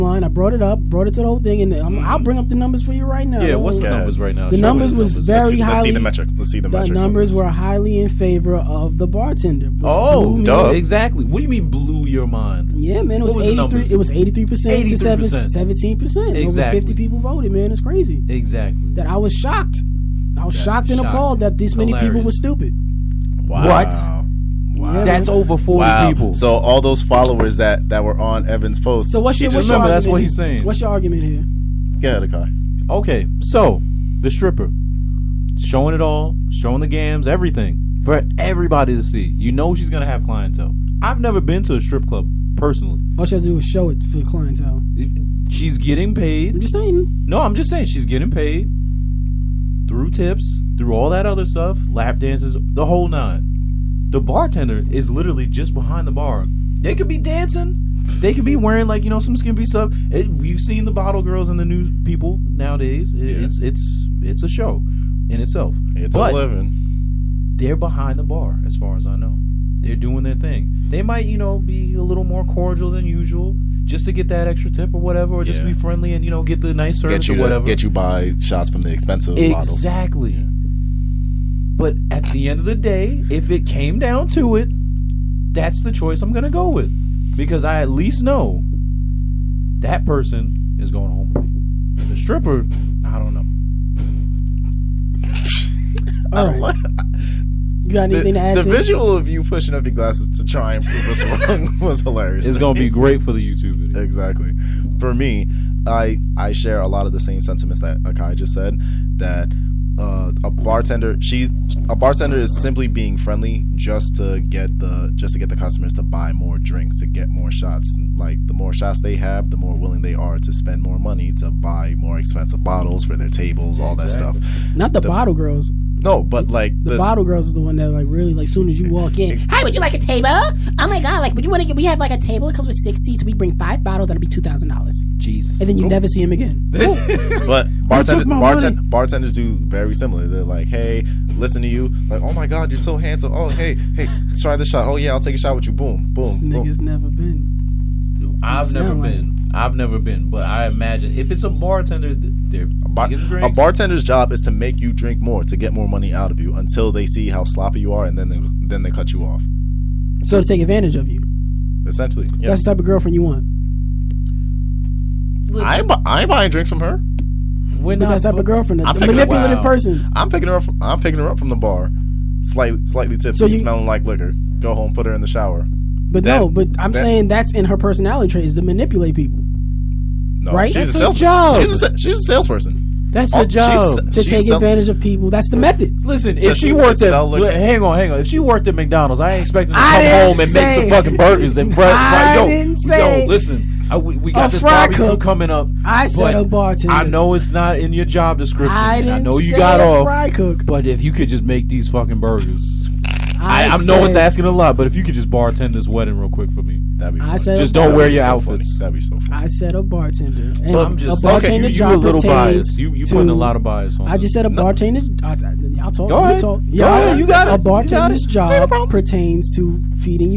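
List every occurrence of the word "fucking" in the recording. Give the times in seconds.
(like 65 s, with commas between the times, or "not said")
190 s, 201 s.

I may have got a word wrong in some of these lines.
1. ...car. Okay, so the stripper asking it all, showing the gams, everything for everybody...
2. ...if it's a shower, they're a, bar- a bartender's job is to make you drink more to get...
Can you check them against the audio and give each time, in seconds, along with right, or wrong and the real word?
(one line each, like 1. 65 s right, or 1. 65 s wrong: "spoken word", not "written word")
1. 32 s wrong: "showing", not "asking"
2. 151 s wrong: "bartender", not "shower".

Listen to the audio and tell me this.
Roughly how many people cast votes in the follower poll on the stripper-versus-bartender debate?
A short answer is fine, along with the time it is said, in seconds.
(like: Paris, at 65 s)
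50, at 16 s.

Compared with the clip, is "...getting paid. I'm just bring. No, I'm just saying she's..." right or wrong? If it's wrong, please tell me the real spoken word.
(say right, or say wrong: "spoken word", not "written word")
wrong: "saying", not "bring".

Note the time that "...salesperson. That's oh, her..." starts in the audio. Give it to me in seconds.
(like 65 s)
182 s.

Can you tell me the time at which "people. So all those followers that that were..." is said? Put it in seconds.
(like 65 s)
26 s.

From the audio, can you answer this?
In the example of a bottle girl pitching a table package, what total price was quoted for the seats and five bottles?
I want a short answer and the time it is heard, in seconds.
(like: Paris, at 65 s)
$2,000, at 134 s.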